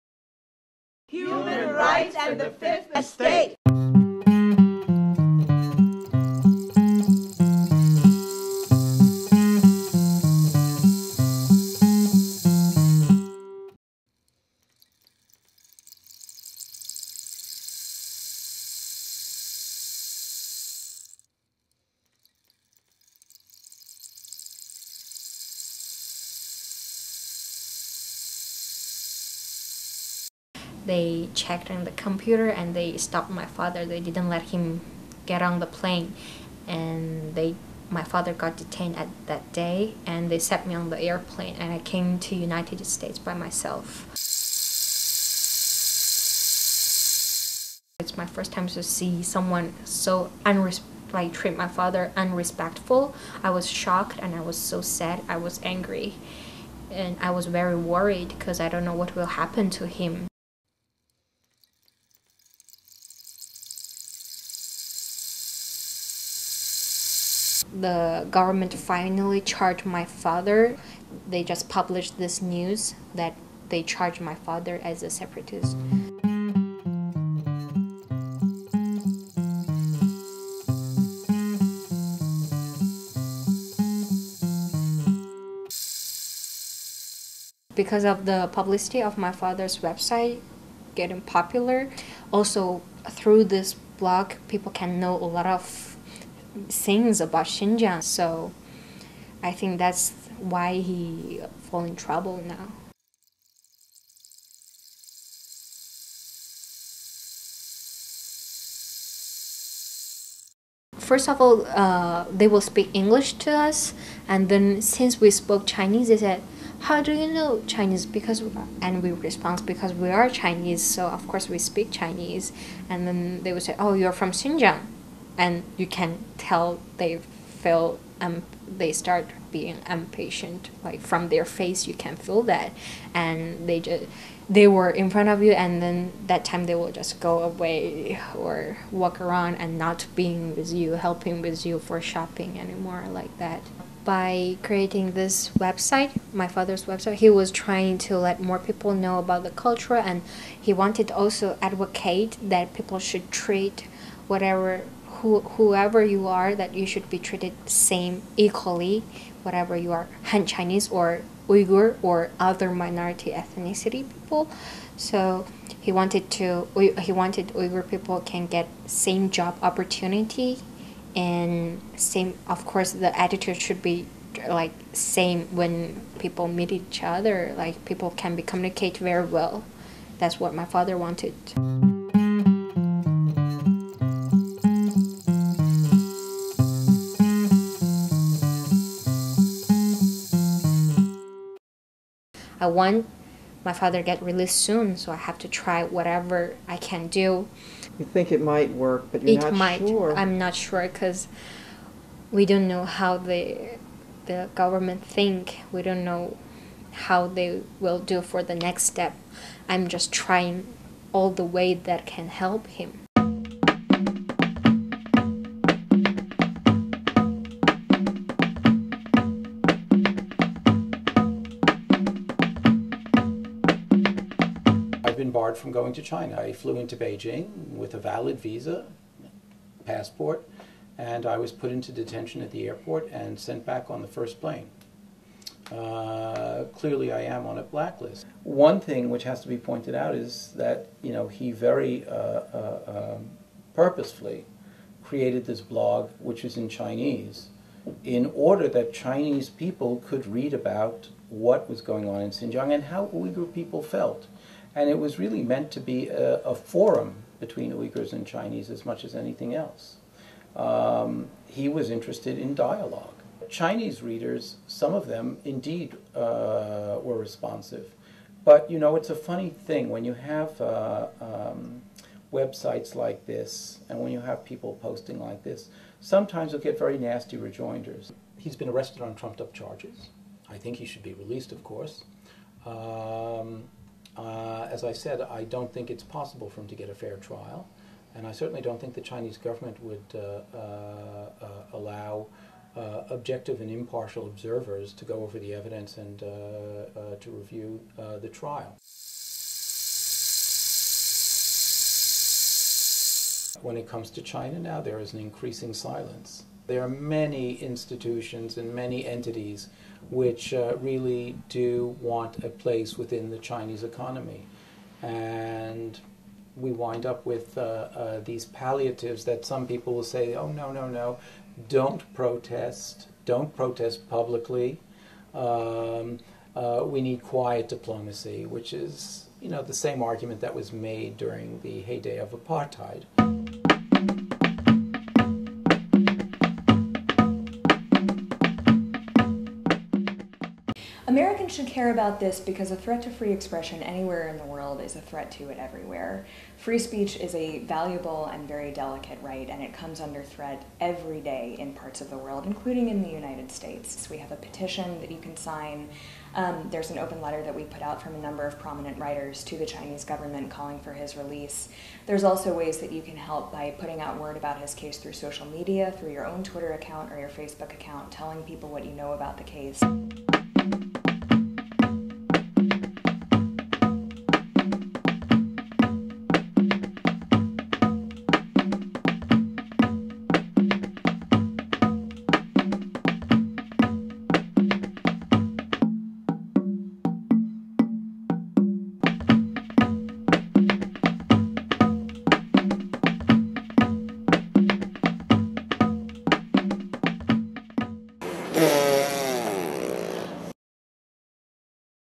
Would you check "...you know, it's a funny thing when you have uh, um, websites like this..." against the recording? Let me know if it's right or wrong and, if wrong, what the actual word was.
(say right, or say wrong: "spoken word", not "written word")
right.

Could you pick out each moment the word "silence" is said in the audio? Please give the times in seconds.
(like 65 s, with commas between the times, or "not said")
305 s.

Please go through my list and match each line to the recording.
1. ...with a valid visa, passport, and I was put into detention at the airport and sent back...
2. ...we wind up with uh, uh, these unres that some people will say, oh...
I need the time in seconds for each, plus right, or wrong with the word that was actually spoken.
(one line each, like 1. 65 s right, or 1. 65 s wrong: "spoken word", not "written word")
1. 227 s right
2. 316 s wrong: "palliatives", not "unres".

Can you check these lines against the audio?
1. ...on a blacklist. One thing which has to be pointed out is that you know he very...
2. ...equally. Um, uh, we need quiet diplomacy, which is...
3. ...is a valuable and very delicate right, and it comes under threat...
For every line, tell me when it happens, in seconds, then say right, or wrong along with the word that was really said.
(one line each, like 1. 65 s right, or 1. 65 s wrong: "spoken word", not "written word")
1. 237 s right
2. 324 s wrong: "publicly", not "equally"
3. 347 s right.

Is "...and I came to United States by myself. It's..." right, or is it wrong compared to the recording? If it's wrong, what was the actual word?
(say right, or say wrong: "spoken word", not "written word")
right.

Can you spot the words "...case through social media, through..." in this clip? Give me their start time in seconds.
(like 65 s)
364 s.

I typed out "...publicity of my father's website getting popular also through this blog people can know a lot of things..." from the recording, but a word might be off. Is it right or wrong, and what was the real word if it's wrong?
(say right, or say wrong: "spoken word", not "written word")
right.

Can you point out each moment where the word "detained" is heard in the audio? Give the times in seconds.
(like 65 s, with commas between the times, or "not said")
38 s.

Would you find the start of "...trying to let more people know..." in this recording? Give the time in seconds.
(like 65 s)
147 s.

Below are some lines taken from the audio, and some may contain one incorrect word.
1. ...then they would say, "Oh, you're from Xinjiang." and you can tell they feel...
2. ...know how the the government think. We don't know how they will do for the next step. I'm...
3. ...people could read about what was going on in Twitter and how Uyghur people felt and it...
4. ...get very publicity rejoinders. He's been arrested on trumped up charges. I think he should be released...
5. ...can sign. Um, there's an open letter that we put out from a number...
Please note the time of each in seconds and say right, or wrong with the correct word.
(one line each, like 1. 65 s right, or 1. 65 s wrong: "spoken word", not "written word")
1. 123 s right
2. 202 s right
3. 249 s wrong: "Xinjiang", not "Twitter"
4. 276 s wrong: "nasty", not "publicity"
5. 355 s right.